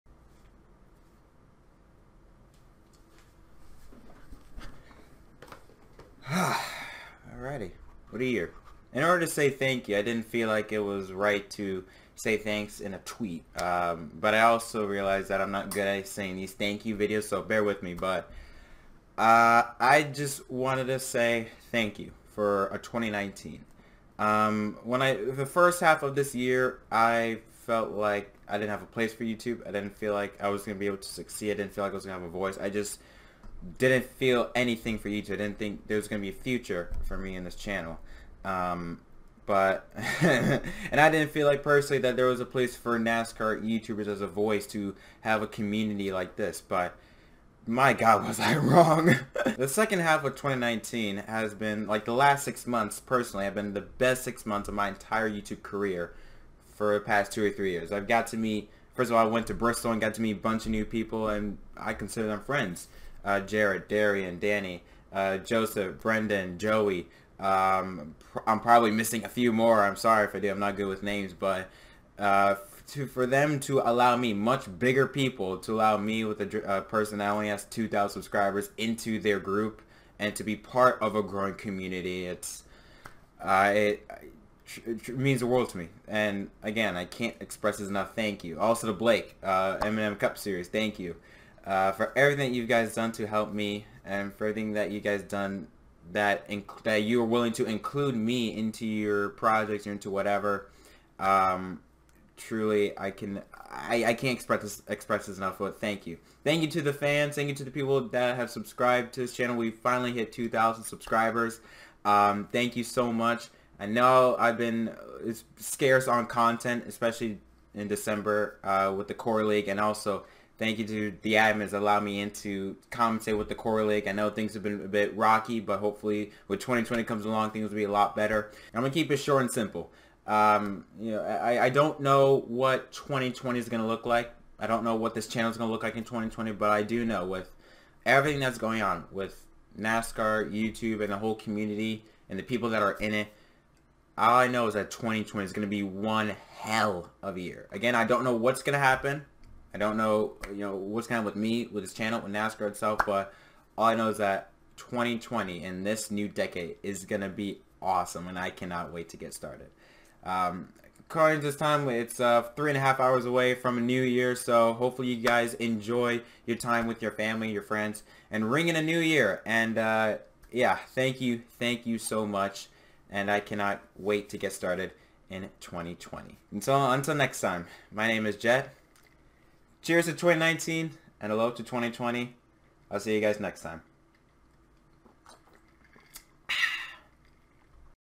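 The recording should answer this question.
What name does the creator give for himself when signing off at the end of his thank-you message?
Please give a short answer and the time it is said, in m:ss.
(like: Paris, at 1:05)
Jett, at 2:58.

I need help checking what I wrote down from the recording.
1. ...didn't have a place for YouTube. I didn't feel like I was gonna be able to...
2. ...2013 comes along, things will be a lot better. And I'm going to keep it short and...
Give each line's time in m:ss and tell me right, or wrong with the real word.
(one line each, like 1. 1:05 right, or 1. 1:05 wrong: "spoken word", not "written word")
1. 0:28 right
2. 2:06 wrong: "2020", not "2013".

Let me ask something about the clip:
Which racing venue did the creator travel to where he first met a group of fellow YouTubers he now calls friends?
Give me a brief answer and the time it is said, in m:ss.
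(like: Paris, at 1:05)
Bristol, at 0:59.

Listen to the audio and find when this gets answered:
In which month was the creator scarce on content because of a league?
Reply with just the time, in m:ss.
1:57.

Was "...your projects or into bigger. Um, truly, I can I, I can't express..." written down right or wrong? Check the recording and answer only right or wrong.
wrong.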